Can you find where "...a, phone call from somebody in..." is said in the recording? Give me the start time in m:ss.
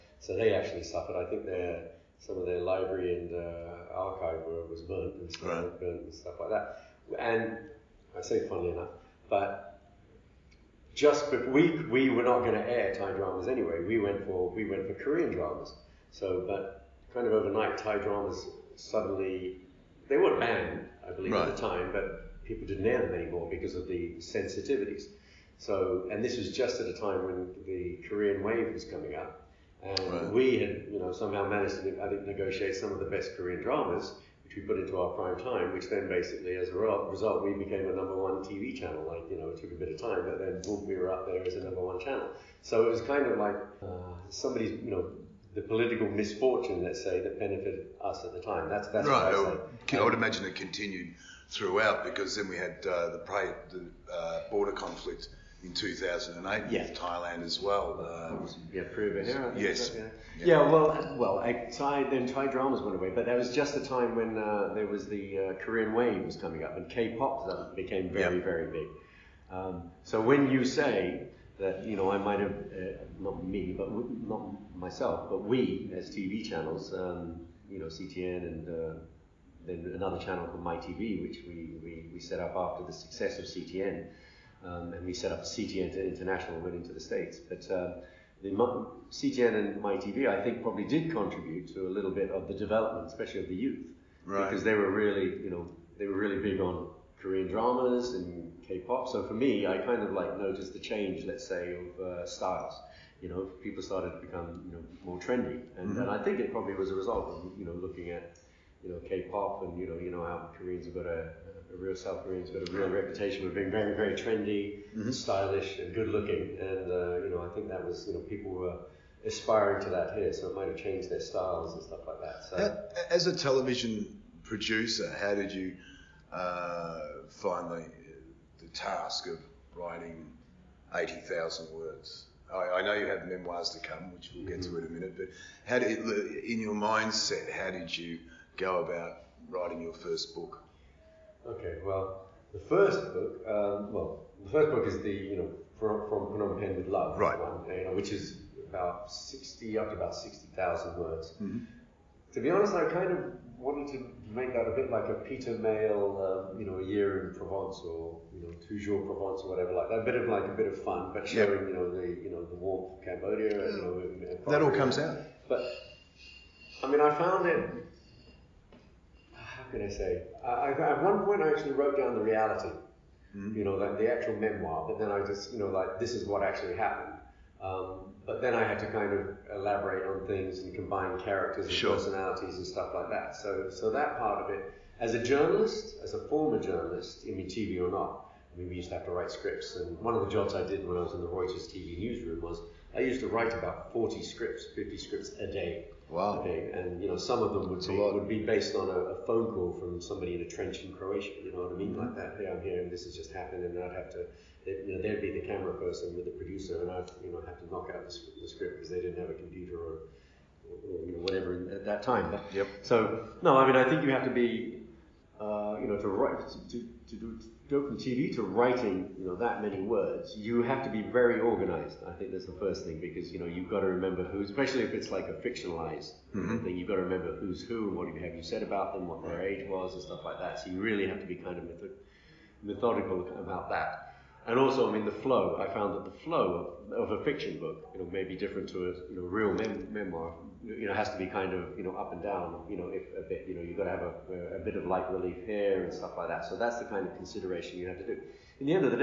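3:19.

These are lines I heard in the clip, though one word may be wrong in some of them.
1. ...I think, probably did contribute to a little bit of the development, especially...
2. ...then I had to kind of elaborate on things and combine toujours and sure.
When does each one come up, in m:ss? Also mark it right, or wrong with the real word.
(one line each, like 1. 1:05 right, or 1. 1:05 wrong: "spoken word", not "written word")
1. 1:30 right
2. 2:58 wrong: "characters", not "toujours".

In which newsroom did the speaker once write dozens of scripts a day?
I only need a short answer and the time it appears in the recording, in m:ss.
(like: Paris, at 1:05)
Reuters TV, at 3:11.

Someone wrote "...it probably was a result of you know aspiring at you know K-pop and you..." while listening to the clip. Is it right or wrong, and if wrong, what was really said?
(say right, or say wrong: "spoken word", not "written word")
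wrong: "looking", not "aspiring".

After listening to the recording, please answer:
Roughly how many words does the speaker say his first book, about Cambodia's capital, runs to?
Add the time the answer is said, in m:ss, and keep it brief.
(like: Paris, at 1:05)
60,000, at 2:30.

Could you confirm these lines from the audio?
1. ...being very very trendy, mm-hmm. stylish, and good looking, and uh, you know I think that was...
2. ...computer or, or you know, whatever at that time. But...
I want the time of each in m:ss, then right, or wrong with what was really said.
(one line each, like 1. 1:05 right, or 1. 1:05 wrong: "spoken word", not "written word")
1. 1:53 right
2. 3:29 right.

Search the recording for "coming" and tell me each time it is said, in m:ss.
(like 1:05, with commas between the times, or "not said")
0:28, 1:06.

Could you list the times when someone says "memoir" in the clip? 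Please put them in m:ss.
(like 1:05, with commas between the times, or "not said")
2:13, 2:54, 3:59.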